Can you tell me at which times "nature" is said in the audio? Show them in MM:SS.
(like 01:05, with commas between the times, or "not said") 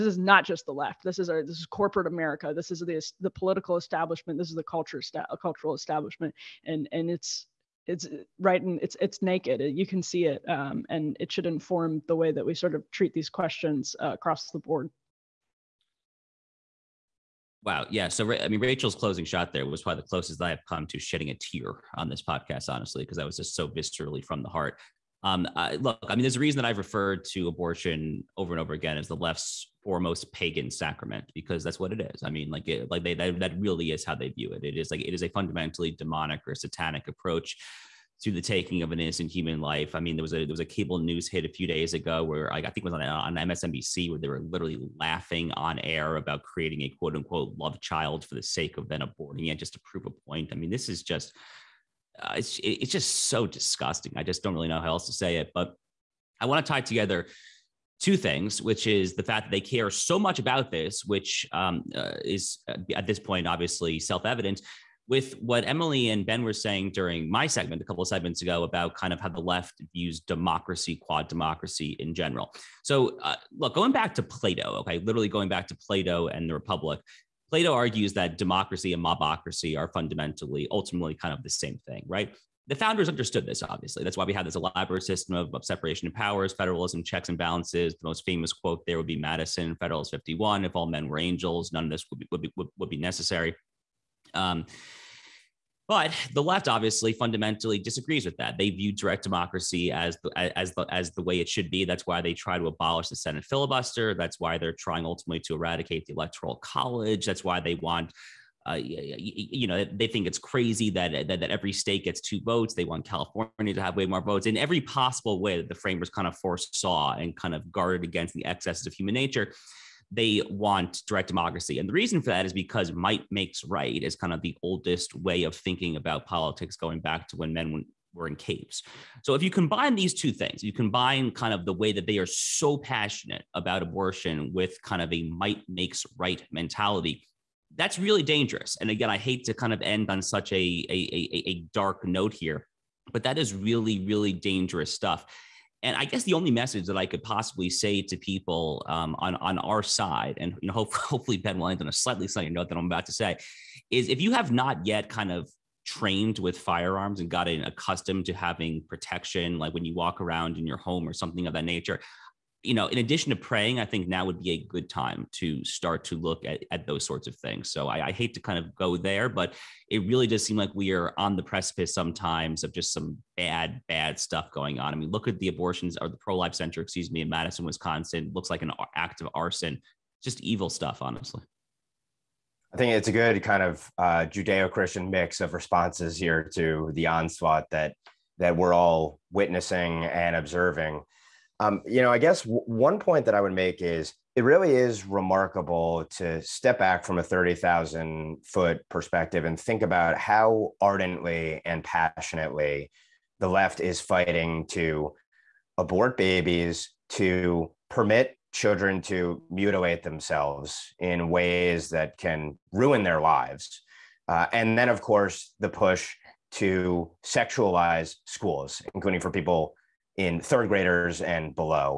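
01:59, 02:41.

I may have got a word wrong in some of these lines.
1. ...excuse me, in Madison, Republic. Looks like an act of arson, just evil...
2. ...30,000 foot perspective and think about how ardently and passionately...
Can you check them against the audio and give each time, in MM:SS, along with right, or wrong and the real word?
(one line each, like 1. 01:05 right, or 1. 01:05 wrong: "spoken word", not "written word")
1. 02:56 wrong: "Wisconsin", not "Republic"
2. 03:17 right.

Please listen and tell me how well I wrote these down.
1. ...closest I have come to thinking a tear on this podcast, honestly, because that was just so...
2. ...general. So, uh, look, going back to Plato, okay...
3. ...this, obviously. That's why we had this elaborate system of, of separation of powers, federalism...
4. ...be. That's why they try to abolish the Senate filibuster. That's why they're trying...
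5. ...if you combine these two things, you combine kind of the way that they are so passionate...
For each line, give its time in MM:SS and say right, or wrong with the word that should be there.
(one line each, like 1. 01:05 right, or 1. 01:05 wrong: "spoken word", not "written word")
1. 00:20 wrong: "shedding", not "thinking"
2. 01:12 right
3. 01:23 right
4. 01:41 right
5. 02:09 right.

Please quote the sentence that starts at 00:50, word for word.
I mean, this is just uh, it's it's just so disgusting.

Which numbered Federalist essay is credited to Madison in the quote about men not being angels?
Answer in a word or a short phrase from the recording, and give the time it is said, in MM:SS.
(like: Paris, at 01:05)
Federalist 51, at 01:29.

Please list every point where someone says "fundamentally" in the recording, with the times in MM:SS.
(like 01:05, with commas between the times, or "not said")
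00:35, 01:19, 01:37.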